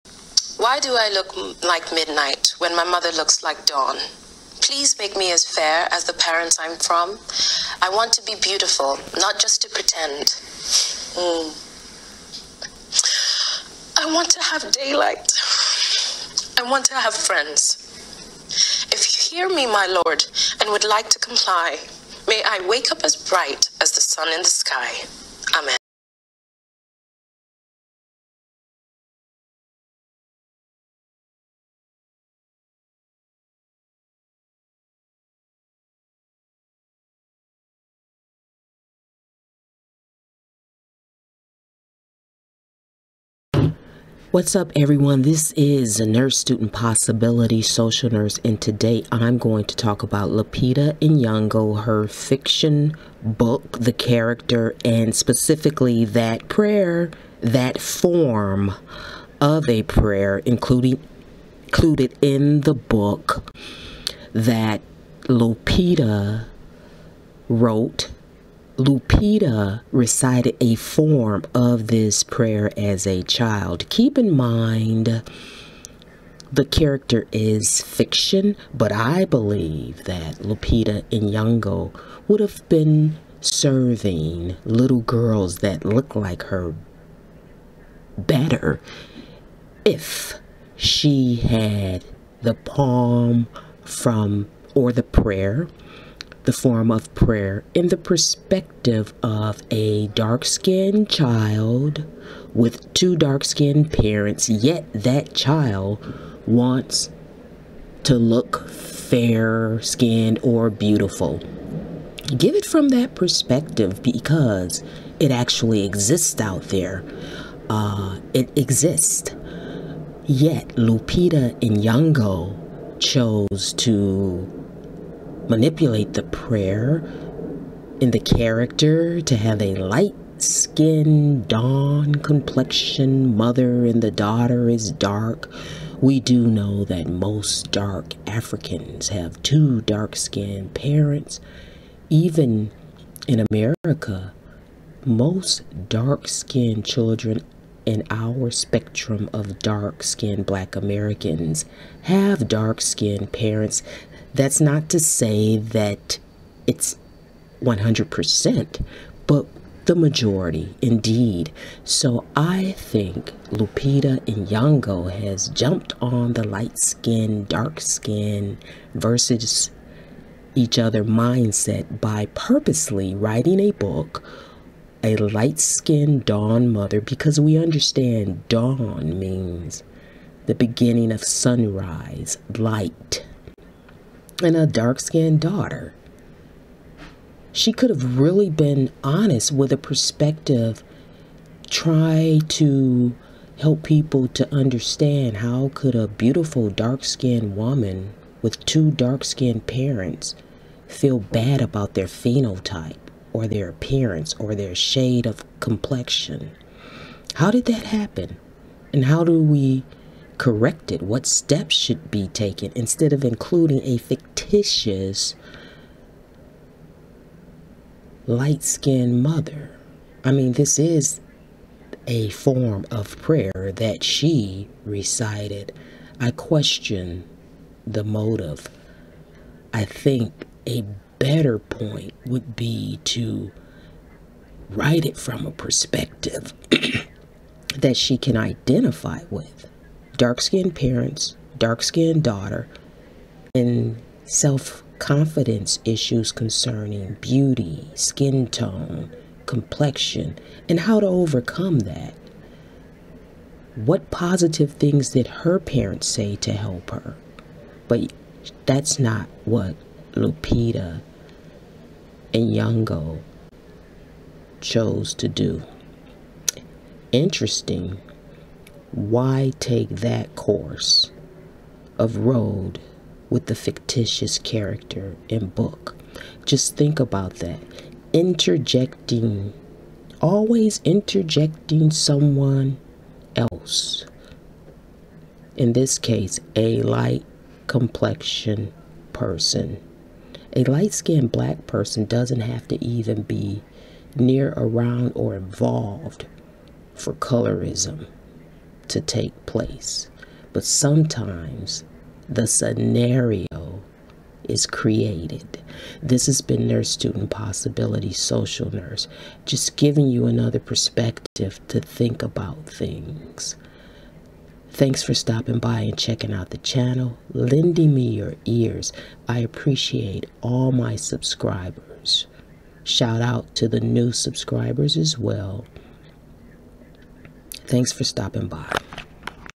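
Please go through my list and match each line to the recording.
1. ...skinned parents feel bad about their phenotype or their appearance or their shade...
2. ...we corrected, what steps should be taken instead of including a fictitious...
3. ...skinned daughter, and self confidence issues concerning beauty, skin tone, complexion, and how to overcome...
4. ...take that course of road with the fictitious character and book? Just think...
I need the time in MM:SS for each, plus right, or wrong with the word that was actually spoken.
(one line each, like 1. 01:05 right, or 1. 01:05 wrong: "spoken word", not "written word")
1. 03:19 right
2. 03:29 right
3. 04:01 right
4. 04:29 right.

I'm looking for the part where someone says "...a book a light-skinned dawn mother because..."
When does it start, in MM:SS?
02:53.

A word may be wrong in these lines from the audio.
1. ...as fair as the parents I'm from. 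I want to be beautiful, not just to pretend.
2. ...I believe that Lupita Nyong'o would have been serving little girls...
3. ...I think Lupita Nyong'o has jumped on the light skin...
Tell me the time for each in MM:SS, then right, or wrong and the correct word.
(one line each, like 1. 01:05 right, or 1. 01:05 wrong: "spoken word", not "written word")
1. 00:05 right
2. 01:18 right
3. 02:42 right.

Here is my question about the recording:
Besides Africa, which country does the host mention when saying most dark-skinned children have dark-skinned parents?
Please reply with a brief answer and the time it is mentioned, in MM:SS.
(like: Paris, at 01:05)
America, at 02:23.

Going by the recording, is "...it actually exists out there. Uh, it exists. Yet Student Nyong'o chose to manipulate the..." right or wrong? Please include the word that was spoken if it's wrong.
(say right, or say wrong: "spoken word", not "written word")
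wrong: "Lupita", not "Student".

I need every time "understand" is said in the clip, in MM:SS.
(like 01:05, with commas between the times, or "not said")
02:57, 03:14.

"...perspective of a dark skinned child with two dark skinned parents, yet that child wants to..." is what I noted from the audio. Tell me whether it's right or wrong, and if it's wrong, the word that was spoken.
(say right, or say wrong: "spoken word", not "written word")
right.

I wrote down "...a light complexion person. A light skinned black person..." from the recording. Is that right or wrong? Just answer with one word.
right.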